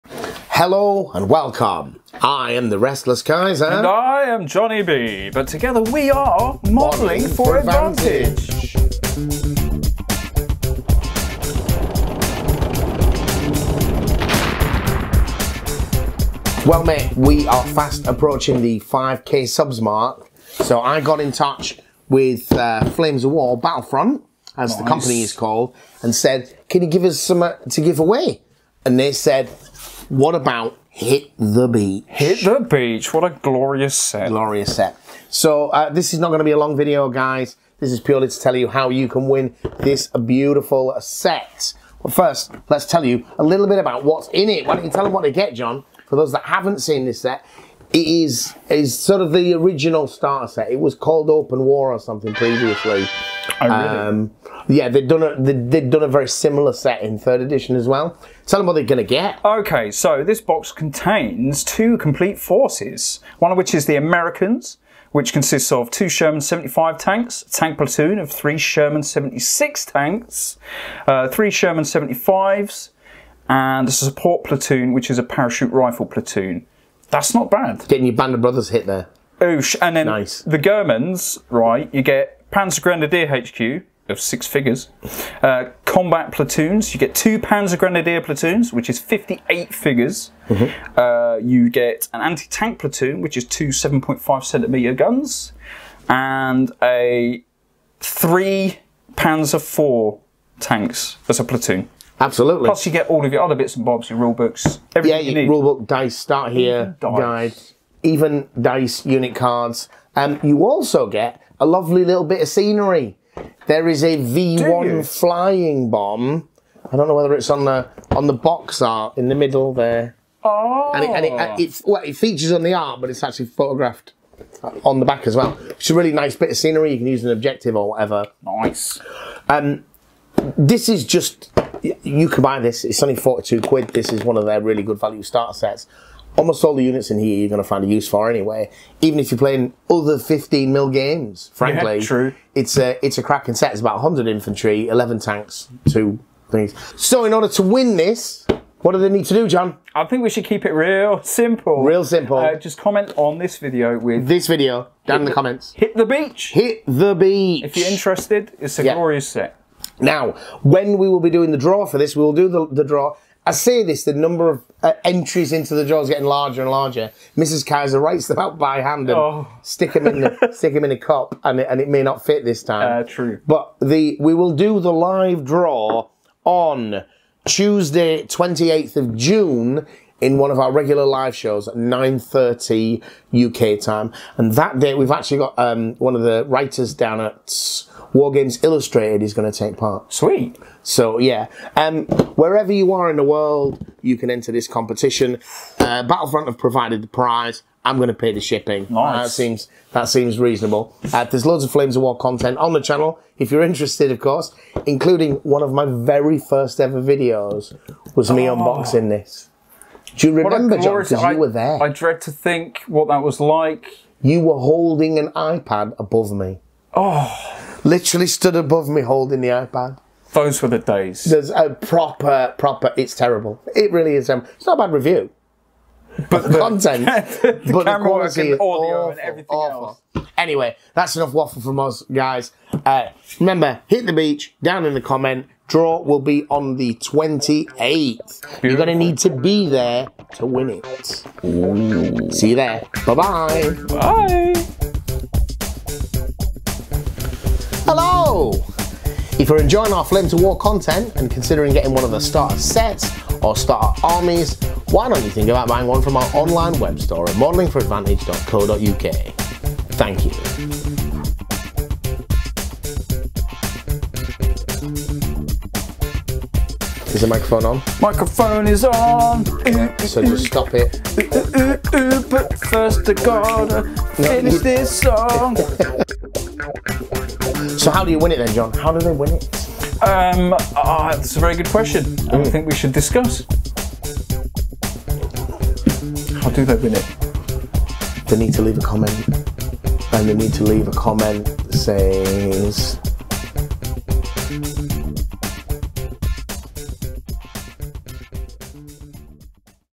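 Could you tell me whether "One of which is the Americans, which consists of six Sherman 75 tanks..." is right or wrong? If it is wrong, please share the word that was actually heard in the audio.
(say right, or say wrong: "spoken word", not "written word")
wrong: "two", not "six".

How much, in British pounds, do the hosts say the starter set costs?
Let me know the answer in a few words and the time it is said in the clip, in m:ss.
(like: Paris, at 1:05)
42 quid, at 2:13.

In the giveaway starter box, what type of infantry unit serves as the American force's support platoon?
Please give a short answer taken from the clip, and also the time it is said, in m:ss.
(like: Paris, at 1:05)
Parachute rifle platoon, at 1:15.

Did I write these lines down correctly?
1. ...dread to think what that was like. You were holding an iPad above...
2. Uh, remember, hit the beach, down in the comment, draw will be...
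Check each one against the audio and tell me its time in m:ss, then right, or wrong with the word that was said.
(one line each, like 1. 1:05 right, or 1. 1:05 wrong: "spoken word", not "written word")
1. 3:31 right
2. 3:52 right.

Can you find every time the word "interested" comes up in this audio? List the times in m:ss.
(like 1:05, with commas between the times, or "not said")
2:37, 3:23.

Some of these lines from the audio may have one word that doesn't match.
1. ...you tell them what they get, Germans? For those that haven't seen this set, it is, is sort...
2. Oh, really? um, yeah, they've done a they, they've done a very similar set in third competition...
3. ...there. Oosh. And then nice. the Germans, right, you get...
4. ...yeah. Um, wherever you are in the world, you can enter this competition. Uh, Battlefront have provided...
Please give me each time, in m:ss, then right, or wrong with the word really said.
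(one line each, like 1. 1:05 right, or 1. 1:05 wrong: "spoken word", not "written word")
1. 0:44 wrong: "John", not "Germans"
2. 0:53 wrong: "edition", not "competition"
3. 1:18 right
4. 3:11 right.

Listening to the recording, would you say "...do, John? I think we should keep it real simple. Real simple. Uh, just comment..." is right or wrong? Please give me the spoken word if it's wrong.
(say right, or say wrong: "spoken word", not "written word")
right.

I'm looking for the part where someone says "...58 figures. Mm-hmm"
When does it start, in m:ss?
1:28.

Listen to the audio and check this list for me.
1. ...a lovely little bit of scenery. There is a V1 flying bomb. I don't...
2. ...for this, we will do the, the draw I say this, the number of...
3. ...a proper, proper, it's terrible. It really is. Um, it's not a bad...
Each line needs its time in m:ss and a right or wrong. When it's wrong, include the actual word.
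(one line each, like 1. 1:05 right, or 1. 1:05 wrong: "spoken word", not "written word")
1. 1:51 right
2. 2:41 right
3. 3:41 right.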